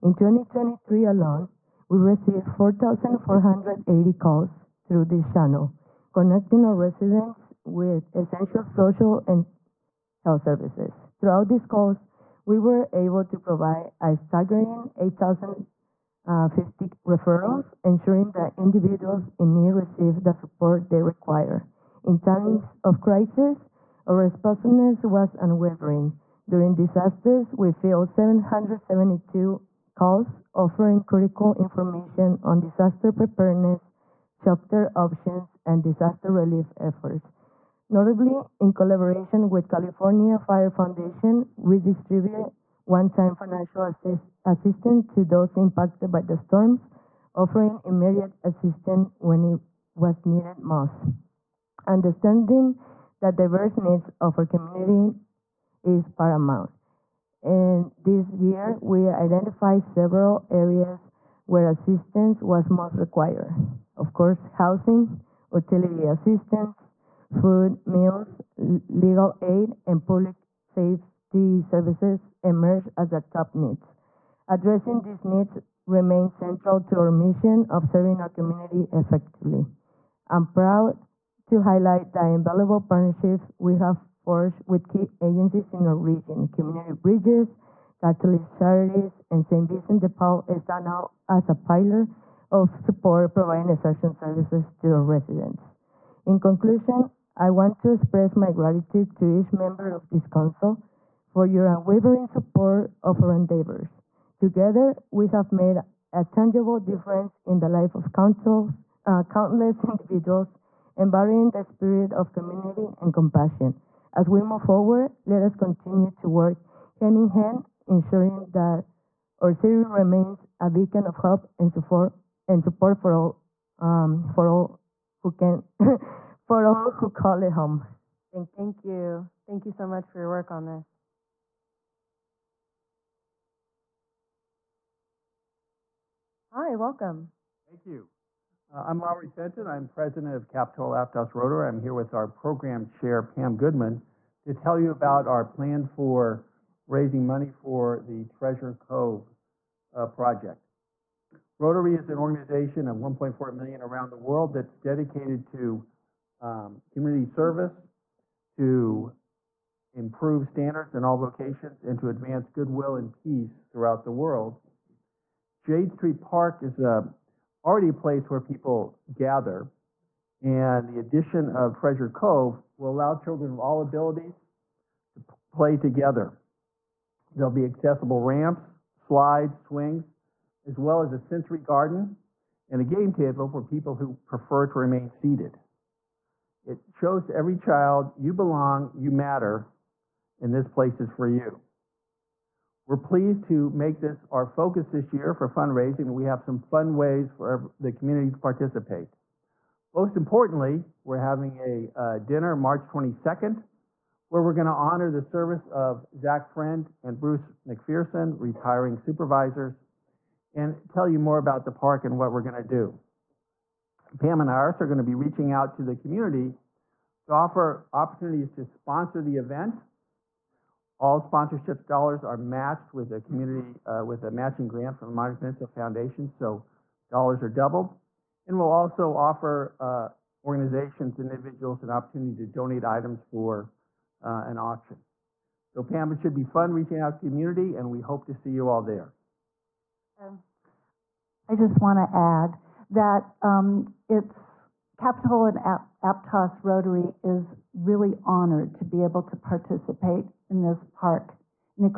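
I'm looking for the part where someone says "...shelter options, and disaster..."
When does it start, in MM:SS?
00:34.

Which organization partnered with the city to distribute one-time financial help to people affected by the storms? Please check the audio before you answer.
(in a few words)
California Fire Foundation.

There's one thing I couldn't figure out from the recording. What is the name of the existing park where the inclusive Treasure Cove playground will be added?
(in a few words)
Jade Street Park.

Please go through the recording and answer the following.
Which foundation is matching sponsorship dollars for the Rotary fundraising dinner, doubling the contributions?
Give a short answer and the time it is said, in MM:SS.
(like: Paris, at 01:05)
Monterey Peninsula Foundation, at 03:45.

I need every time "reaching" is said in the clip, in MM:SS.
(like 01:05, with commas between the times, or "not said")
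03:35, 03:56.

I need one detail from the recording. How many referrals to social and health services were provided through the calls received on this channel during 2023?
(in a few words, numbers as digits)
8,050.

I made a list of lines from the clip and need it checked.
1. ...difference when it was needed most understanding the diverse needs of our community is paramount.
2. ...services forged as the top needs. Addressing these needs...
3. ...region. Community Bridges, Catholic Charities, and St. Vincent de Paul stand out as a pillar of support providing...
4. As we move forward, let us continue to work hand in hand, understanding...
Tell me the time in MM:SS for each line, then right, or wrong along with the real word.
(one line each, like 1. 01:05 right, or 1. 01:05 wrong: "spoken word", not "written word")
1. 00:48 wrong: "assistance", not "difference"
2. 01:11 wrong: "emerged", not "forged"
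3. 01:25 right
4. 01:54 wrong: "ensuring", not "understanding".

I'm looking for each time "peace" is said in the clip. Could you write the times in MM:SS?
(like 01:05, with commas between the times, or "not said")
02:43.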